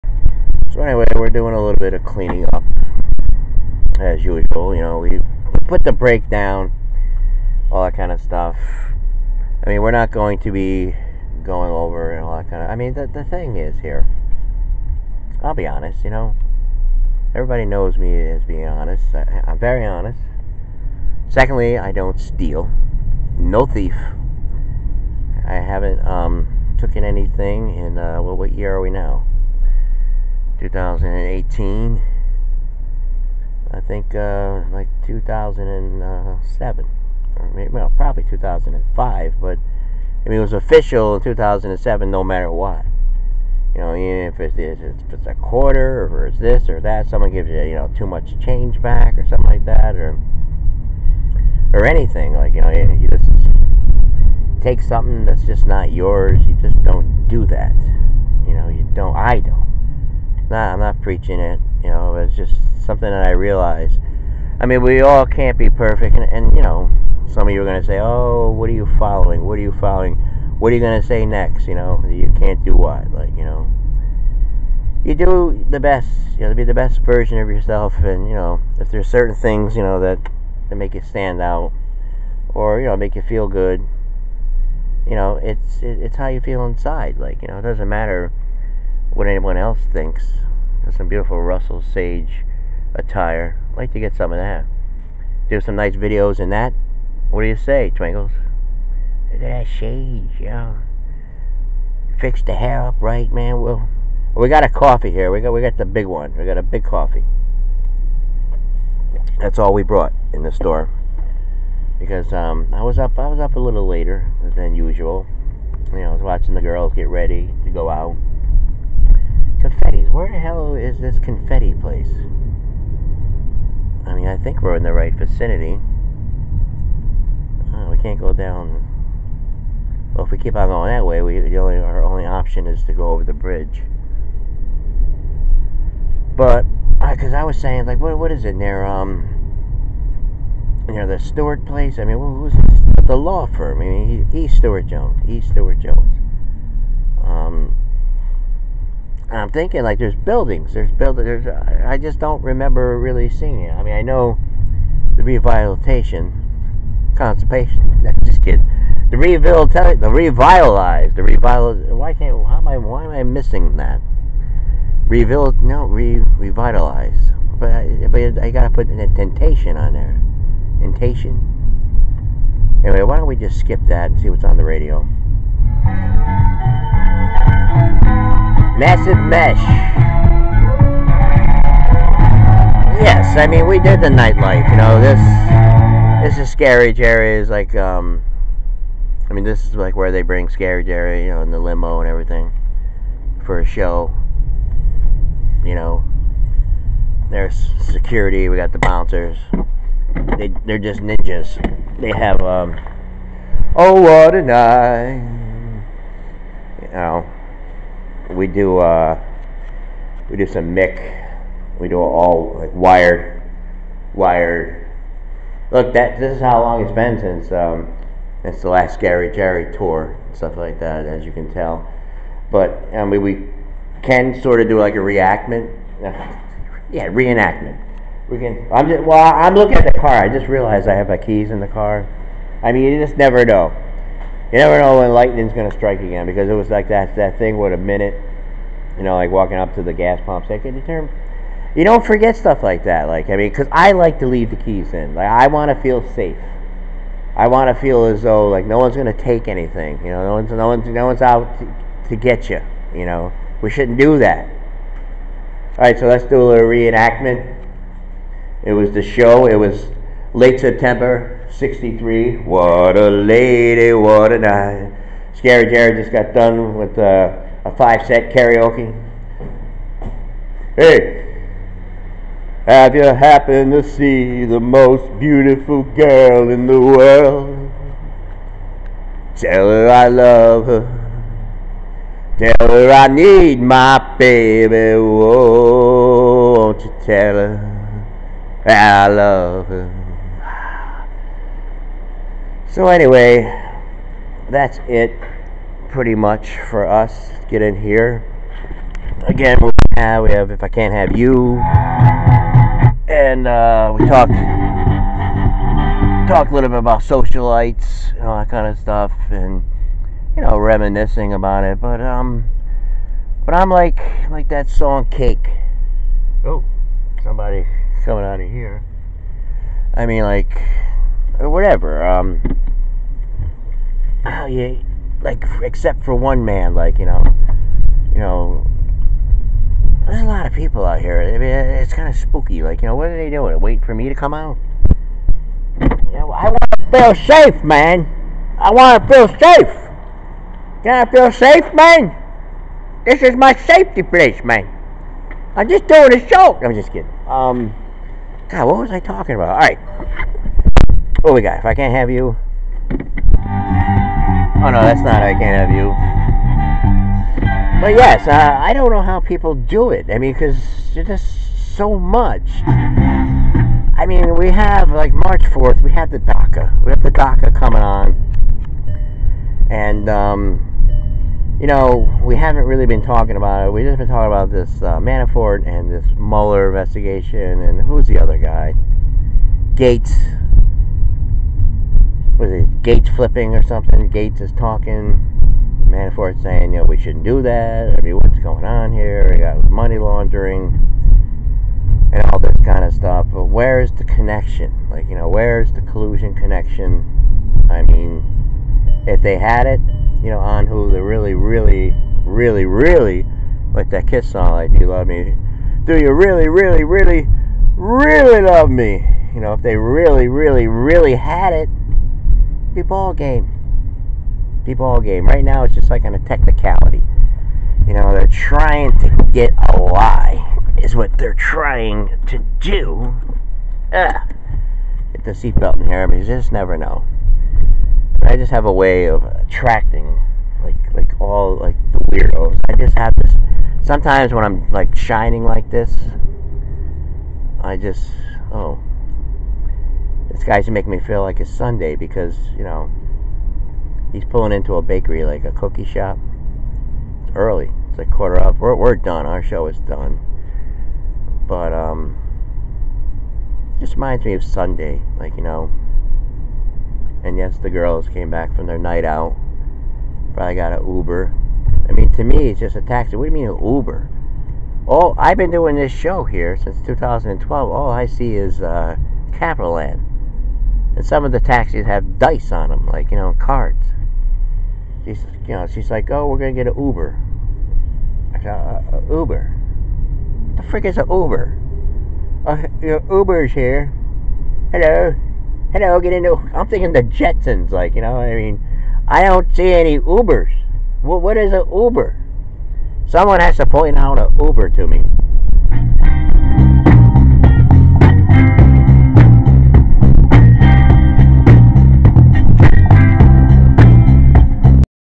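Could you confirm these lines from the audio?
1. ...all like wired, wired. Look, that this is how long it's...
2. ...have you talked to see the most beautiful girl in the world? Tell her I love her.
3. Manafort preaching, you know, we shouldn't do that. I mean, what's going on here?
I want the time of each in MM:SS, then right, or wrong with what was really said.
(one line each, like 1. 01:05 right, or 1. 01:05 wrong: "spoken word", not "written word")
1. 03:31 right
2. 04:32 wrong: "happened", not "talked"
3. 06:25 wrong: "saying", not "preaching".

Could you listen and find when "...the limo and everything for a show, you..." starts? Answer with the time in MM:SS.
03:11.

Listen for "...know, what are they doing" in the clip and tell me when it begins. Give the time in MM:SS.
05:32.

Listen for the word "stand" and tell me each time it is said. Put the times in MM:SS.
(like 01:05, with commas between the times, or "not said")
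01:21.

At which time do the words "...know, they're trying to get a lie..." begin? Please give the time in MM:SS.
06:57.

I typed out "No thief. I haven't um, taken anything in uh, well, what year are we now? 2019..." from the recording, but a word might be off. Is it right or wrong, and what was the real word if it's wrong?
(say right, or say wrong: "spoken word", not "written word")
wrong: "2018", not "2019".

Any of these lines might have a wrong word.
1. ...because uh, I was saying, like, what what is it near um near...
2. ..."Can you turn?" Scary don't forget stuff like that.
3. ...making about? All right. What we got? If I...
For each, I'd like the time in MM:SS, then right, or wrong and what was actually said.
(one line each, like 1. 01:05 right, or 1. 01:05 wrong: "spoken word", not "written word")
1. 02:17 right
2. 04:00 wrong: "You", not "Scary"
3. 05:48 wrong: "talking", not "making".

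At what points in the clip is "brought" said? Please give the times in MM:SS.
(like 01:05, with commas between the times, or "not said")
01:49.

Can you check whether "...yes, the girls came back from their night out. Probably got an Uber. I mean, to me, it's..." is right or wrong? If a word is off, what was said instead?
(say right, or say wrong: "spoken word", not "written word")
right.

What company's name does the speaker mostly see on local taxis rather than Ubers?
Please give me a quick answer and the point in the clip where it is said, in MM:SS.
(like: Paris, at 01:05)
Capital Land, at 07:49.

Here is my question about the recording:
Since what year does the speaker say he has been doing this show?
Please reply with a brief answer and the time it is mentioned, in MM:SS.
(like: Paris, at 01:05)
2012, at 07:46.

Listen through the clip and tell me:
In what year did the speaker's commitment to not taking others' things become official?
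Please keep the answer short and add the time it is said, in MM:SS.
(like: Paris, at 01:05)
2007, at 00:40.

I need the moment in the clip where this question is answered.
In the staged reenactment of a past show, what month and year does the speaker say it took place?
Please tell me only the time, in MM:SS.
04:20.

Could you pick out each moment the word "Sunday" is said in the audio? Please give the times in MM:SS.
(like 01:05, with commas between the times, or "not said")
07:21, 07:34.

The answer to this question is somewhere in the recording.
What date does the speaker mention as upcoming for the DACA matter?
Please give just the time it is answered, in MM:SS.
06:05.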